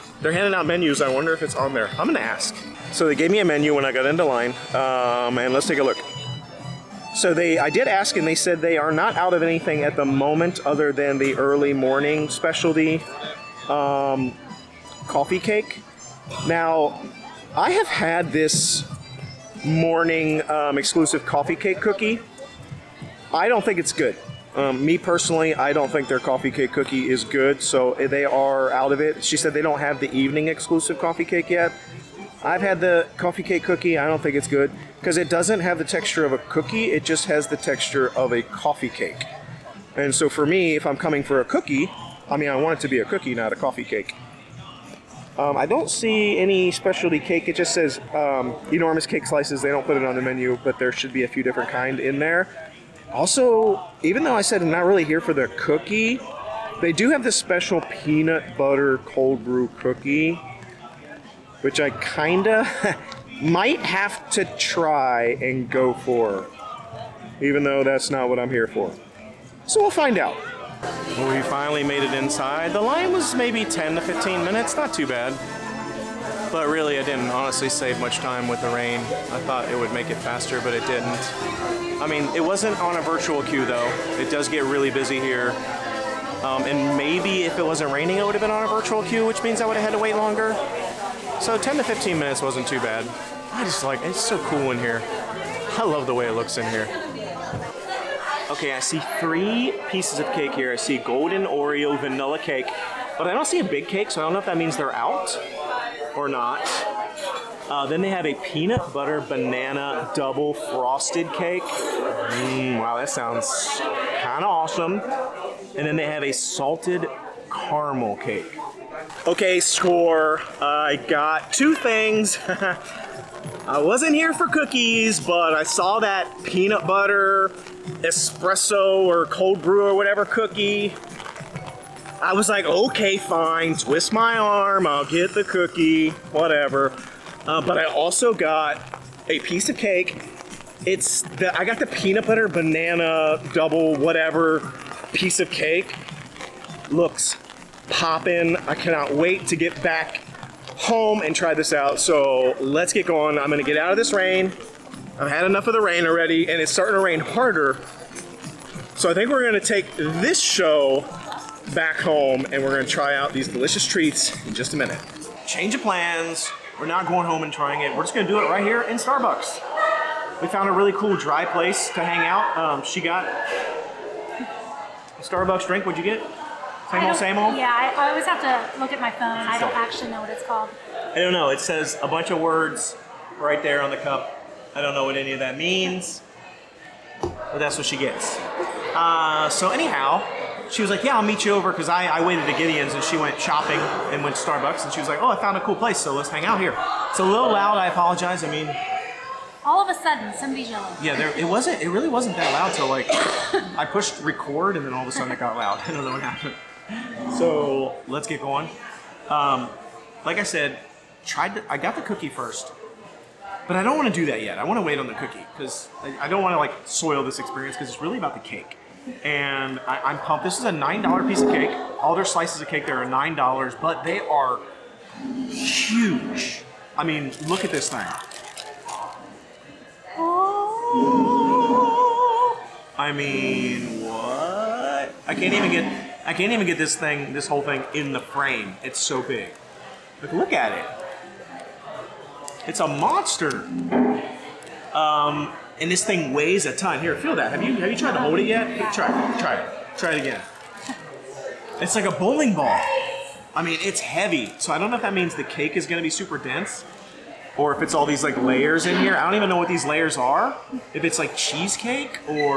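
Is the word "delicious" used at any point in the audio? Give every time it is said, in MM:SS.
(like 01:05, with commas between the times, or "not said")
02:43.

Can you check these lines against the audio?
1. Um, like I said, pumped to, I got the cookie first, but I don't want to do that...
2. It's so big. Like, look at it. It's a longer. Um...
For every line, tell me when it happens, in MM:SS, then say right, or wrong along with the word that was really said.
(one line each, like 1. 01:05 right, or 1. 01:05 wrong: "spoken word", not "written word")
1. 03:29 wrong: "tried", not "pumped"
2. 03:58 wrong: "monster", not "longer".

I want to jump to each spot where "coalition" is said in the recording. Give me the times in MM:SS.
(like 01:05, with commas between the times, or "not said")
not said.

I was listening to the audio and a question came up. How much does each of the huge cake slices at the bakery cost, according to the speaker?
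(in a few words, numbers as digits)
$9.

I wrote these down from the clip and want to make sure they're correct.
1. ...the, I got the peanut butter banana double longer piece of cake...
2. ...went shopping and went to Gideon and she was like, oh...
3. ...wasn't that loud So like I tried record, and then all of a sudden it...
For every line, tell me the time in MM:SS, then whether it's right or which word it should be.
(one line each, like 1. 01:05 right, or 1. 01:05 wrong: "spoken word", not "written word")
1. 02:21 wrong: "whatever", not "longer"
2. 03:13 wrong: "Starbucks", not "Gideon"
3. 03:22 wrong: "pushed", not "tried".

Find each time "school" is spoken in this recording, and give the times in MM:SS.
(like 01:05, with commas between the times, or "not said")
not said.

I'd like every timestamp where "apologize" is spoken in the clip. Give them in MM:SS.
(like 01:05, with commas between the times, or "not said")
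03:17.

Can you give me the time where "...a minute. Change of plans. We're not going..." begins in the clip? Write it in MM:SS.
02:44.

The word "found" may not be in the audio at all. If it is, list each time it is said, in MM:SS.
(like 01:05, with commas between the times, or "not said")
02:50, 03:15.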